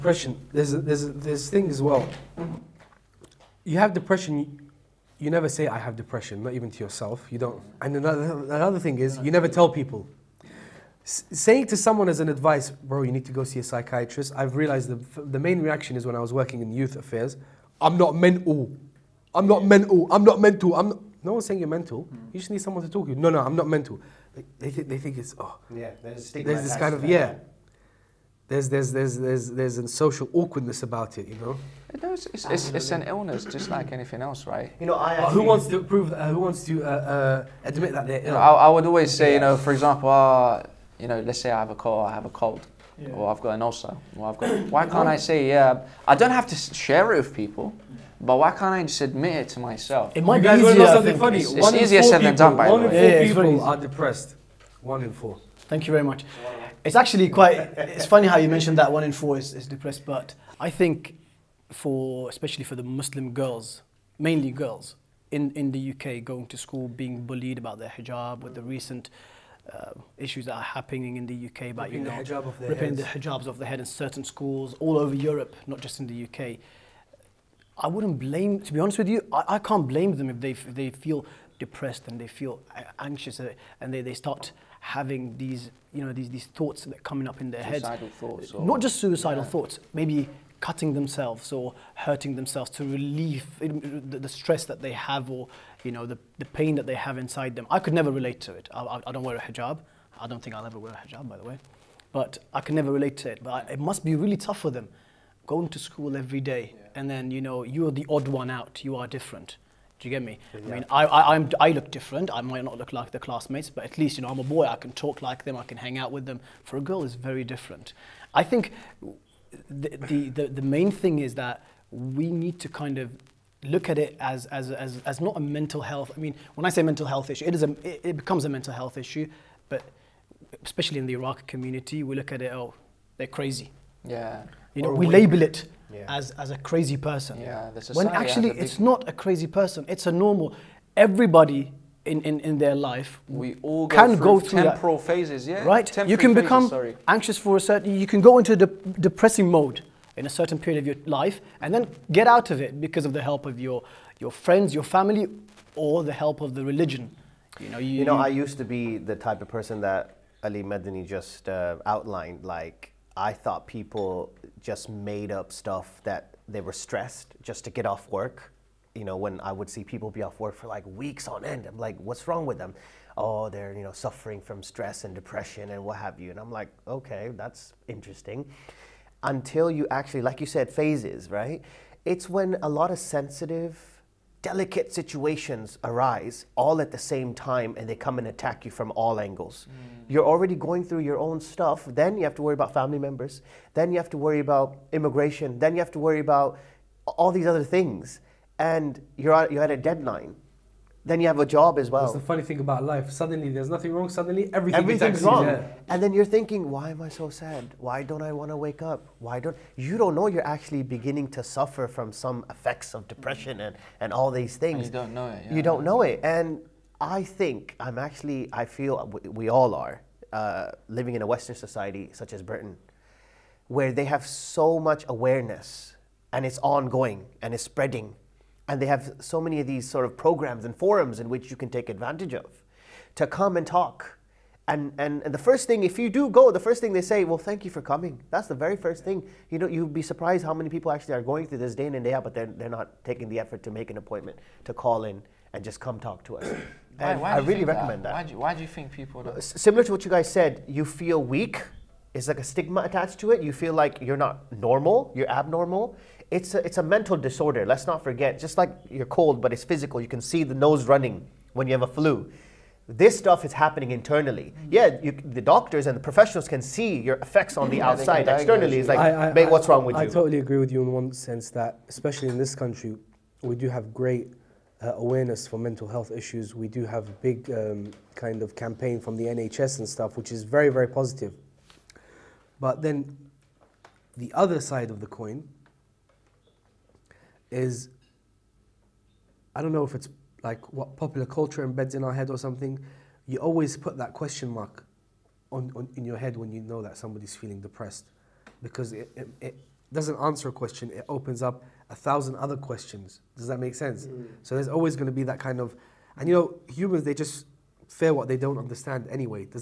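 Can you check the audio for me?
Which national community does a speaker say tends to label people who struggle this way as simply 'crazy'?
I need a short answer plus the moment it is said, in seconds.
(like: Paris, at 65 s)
Iraqi, at 131 s.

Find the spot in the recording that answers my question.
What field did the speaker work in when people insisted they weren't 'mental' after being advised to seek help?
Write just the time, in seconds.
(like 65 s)
16 s.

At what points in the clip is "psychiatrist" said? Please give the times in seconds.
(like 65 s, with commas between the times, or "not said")
13 s.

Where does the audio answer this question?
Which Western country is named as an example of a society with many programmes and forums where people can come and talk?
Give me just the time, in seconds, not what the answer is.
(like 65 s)
222 s.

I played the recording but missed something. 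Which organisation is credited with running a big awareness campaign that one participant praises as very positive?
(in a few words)
NHS.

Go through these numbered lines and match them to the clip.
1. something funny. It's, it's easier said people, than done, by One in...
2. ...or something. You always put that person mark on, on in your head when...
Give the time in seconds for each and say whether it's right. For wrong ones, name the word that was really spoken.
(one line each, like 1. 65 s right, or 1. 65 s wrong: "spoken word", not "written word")
1. 50 s right
2. 292 s wrong: "question", not "person".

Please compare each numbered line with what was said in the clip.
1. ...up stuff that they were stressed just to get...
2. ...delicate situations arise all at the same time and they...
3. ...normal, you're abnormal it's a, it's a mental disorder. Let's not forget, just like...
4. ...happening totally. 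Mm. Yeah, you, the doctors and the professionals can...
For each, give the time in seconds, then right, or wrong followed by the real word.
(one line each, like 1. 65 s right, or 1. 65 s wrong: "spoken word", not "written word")
1. 165 s right
2. 184 s right
3. 254 s right
4. 263 s wrong: "internally", not "totally".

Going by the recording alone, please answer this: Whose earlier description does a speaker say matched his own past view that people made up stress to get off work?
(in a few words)
Ali Medini.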